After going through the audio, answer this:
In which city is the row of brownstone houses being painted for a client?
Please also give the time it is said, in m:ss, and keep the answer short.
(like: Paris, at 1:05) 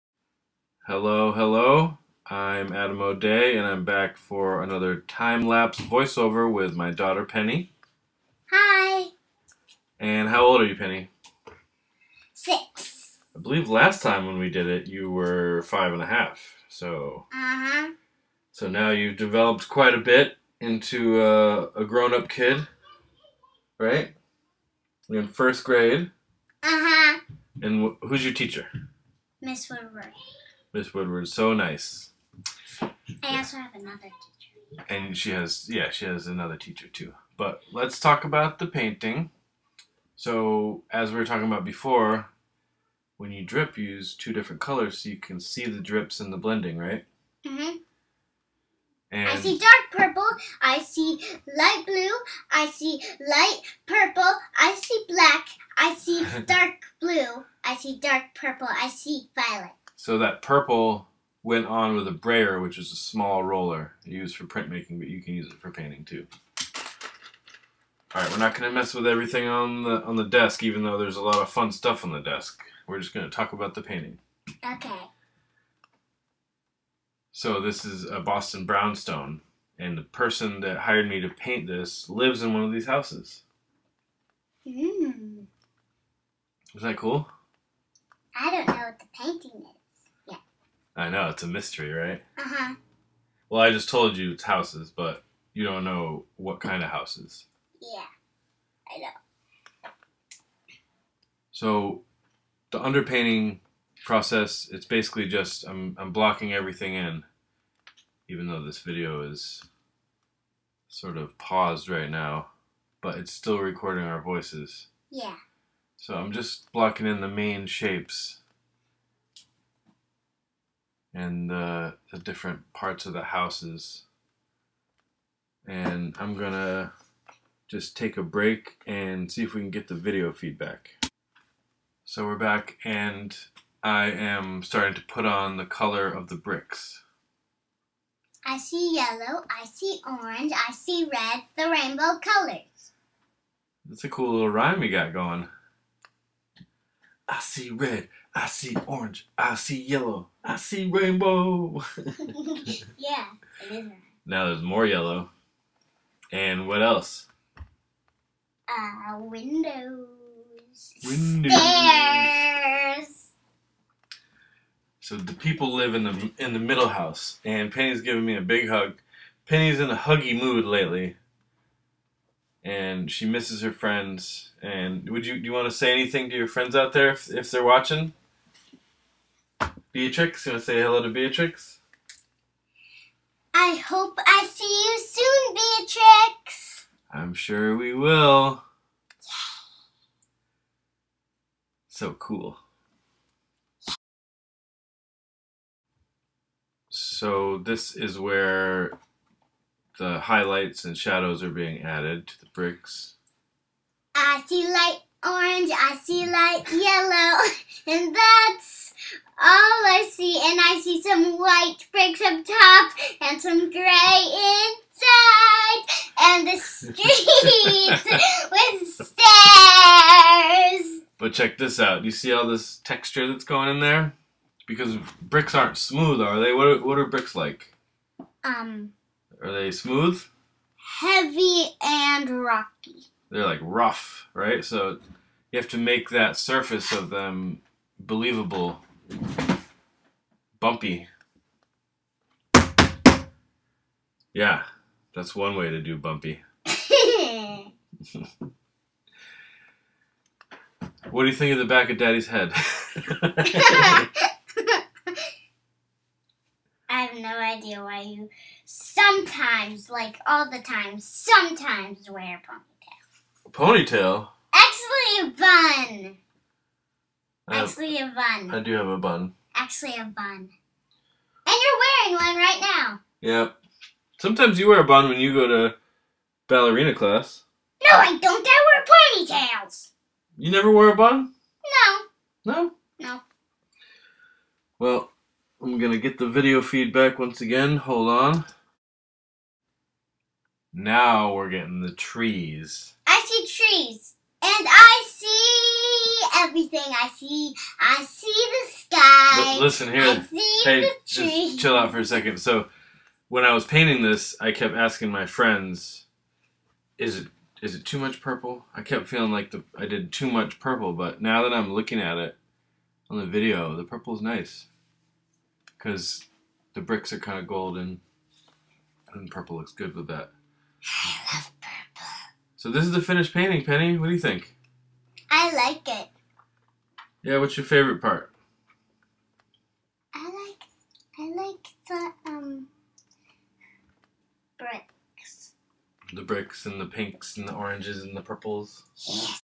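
Boston, at 1:18.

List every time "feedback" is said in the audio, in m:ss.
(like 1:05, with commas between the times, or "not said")
2:10, 4:46.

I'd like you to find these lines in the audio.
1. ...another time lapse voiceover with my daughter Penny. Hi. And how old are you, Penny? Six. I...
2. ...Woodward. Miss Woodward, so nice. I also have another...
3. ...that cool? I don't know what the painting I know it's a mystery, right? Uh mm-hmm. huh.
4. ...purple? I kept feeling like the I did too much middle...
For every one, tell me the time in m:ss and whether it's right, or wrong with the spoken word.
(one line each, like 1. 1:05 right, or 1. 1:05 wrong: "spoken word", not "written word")
1. 0:04 right
2. 0:29 right
3. 1:26 right
4. 5:08 wrong: "purple", not "middle".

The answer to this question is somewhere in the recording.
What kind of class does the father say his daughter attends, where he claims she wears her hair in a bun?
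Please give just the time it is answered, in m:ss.
4:36.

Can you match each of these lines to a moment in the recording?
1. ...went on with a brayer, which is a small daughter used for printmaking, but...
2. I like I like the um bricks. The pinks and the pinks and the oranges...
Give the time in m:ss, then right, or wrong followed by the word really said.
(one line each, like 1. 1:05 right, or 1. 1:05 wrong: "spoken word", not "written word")
1. 1:01 wrong: "roller", not "daughter"
2. 5:30 wrong: "bricks", not "pinks".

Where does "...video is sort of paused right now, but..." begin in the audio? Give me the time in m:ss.
1:48.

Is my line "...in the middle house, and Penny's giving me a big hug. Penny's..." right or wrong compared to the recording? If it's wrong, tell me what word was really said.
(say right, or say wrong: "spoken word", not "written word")
right.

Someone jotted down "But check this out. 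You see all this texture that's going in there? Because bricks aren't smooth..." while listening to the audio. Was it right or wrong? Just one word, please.
right.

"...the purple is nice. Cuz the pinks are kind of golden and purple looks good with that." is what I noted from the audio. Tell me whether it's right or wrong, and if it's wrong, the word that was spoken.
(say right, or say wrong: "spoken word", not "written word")
wrong: "bricks", not "pinks".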